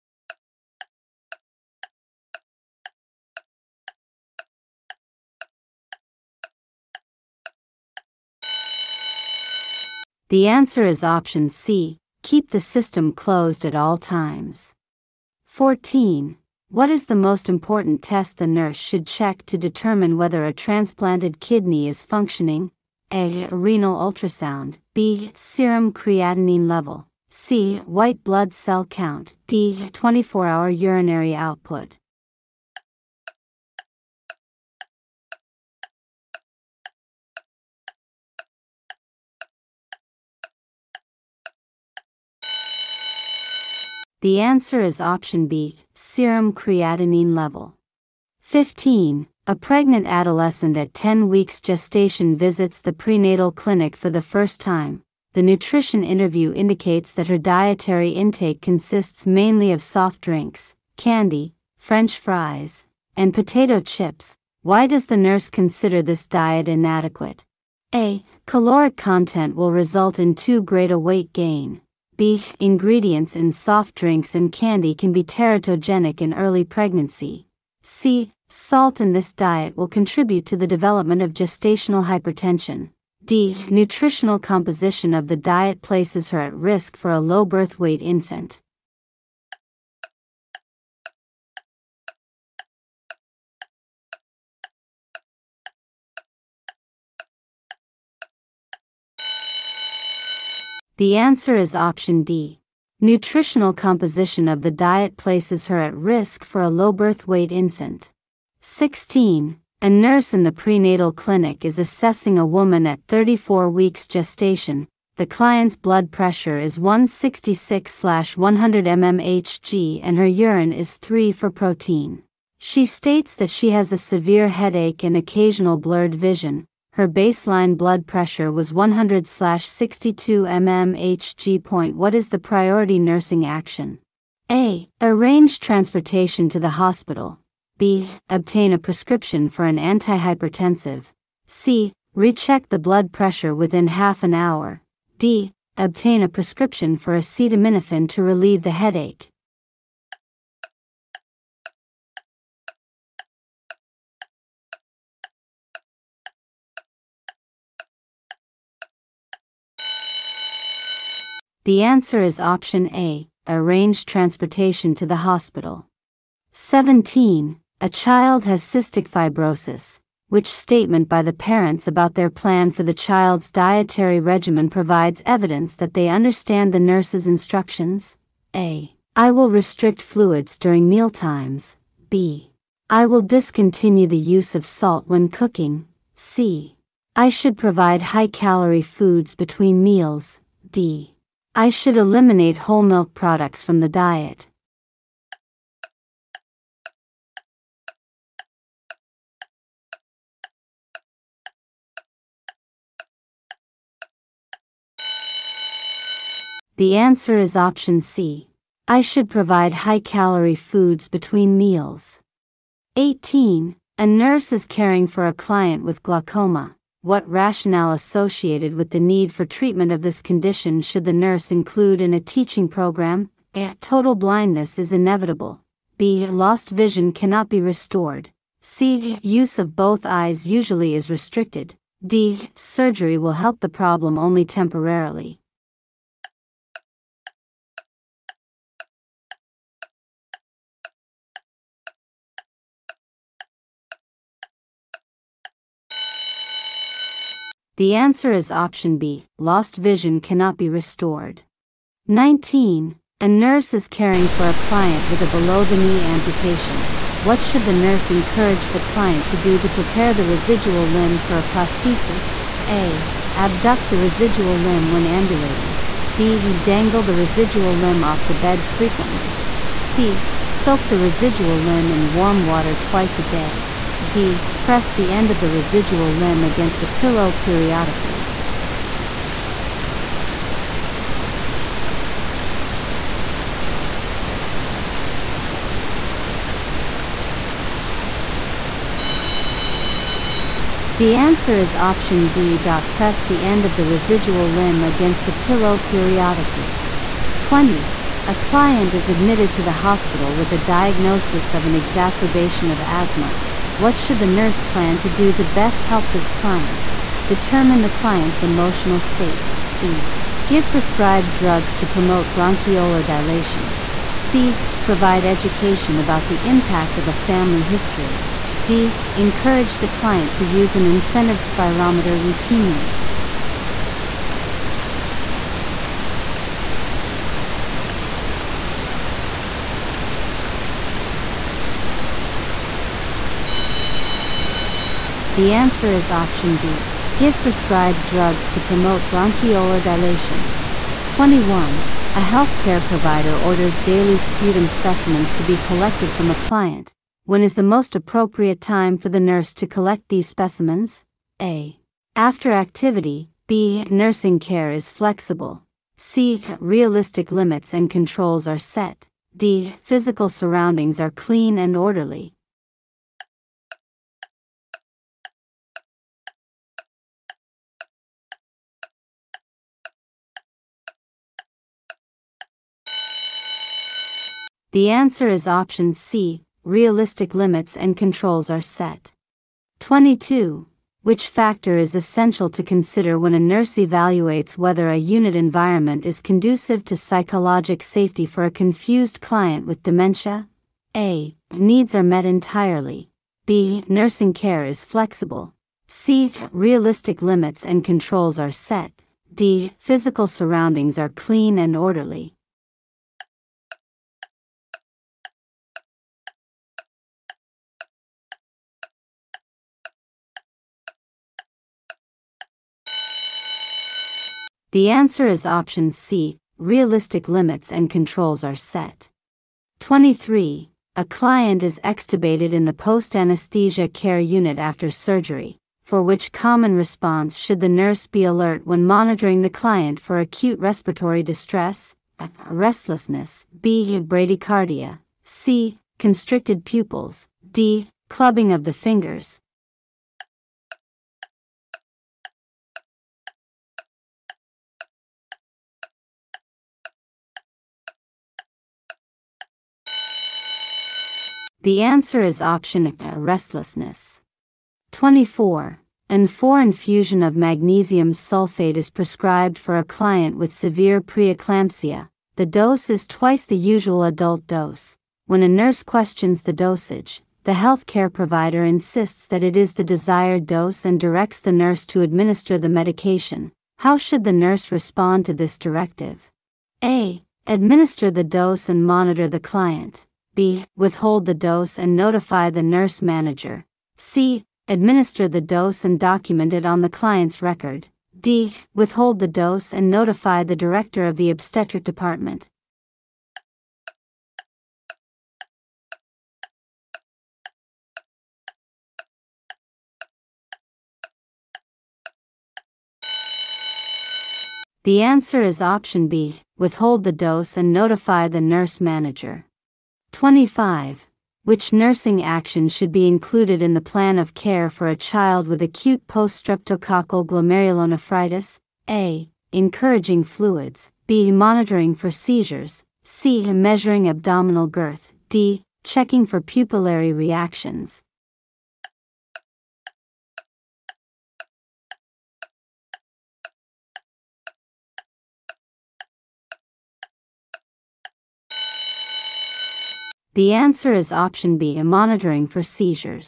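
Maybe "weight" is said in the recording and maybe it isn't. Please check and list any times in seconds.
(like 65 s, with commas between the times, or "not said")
70 s, 87 s, 107 s.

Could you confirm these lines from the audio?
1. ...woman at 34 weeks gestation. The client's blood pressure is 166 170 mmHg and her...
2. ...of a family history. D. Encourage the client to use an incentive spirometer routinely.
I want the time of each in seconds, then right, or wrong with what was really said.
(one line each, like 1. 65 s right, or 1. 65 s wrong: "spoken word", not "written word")
1. 112 s wrong: "100", not "170"
2. 316 s right.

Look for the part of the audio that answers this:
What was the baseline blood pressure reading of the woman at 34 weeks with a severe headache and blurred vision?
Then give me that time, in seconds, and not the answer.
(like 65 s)
128 s.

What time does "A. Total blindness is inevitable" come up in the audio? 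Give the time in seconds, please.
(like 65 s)
223 s.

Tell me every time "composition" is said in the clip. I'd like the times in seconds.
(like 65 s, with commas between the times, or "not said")
84 s, 103 s.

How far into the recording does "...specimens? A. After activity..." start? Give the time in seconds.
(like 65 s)
350 s.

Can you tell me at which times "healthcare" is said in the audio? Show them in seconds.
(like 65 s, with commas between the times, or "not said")
342 s, 467 s.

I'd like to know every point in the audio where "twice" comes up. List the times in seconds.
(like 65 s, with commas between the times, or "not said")
272 s, 463 s.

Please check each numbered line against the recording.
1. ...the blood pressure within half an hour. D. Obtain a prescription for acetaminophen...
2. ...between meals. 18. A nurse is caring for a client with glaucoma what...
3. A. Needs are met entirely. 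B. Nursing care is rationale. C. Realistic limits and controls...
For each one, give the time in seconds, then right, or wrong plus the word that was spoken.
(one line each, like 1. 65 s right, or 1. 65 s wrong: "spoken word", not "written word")
1. 142 s right
2. 211 s right
3. 390 s wrong: "flexible", not "rationale".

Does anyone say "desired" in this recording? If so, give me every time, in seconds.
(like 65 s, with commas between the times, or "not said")
469 s.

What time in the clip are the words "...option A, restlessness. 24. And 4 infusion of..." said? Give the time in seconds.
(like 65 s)
452 s.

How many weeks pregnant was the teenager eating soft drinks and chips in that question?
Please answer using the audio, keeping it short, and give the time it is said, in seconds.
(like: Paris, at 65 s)
10, at 50 s.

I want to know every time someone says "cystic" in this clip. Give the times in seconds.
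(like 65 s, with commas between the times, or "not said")
168 s.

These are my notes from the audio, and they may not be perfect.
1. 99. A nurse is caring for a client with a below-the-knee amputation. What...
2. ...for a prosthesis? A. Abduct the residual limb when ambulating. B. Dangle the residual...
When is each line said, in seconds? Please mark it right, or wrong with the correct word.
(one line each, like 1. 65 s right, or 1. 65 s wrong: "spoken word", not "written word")
1. 252 s wrong: "19", not "99"
2. 261 s right.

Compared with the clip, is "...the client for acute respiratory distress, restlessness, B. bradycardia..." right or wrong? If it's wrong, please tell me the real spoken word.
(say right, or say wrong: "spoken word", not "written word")
right.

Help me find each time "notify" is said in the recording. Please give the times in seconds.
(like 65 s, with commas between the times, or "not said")
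481 s, 489 s, 507 s.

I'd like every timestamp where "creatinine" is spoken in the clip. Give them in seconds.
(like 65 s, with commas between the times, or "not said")
25 s, 46 s.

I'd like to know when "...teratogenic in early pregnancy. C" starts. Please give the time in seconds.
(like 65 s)
75 s.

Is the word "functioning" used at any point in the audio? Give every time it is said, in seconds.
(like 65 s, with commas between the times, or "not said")
22 s.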